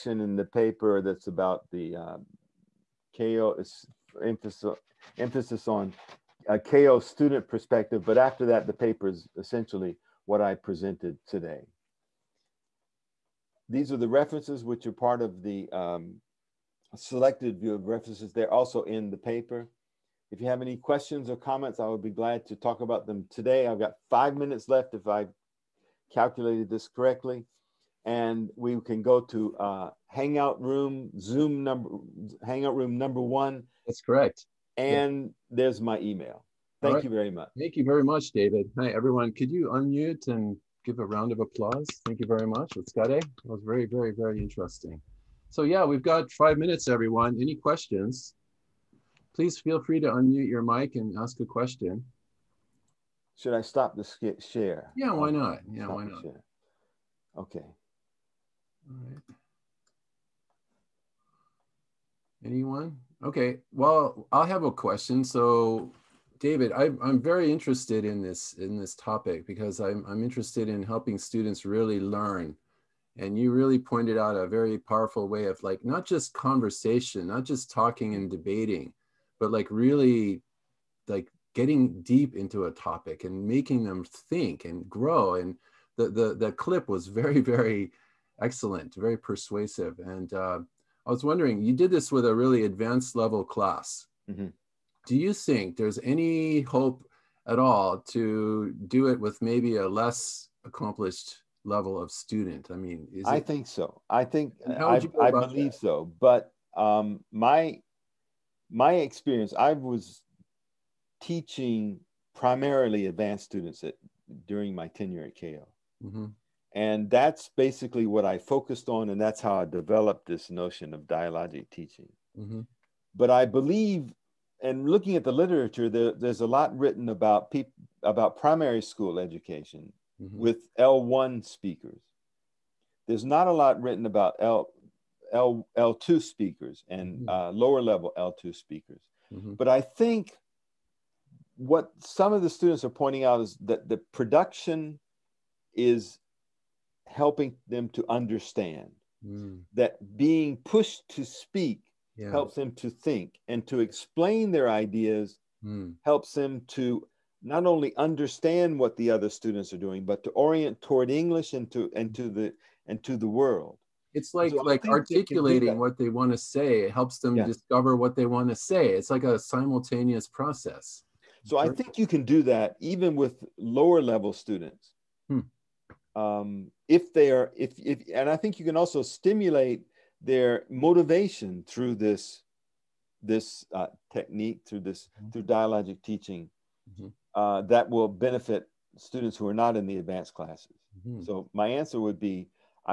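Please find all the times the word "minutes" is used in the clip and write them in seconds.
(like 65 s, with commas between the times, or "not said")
24 s, 46 s.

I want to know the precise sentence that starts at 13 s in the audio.
These are the references which are part of the um, selected view of references.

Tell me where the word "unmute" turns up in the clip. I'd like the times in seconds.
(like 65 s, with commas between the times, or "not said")
39 s, 50 s.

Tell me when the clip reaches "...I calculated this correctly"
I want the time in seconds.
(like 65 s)
25 s.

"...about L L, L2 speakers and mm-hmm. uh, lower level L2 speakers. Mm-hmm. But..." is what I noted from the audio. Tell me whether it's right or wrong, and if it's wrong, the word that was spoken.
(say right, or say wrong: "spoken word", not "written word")
right.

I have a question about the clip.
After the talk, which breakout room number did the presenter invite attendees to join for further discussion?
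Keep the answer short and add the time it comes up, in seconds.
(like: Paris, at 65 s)
1, at 32 s.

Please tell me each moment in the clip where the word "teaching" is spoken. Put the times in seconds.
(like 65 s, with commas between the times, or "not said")
111 s, 121 s, 186 s.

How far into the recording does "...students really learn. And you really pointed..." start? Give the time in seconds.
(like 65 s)
71 s.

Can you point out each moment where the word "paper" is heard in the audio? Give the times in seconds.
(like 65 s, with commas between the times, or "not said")
0 s, 8 s, 19 s.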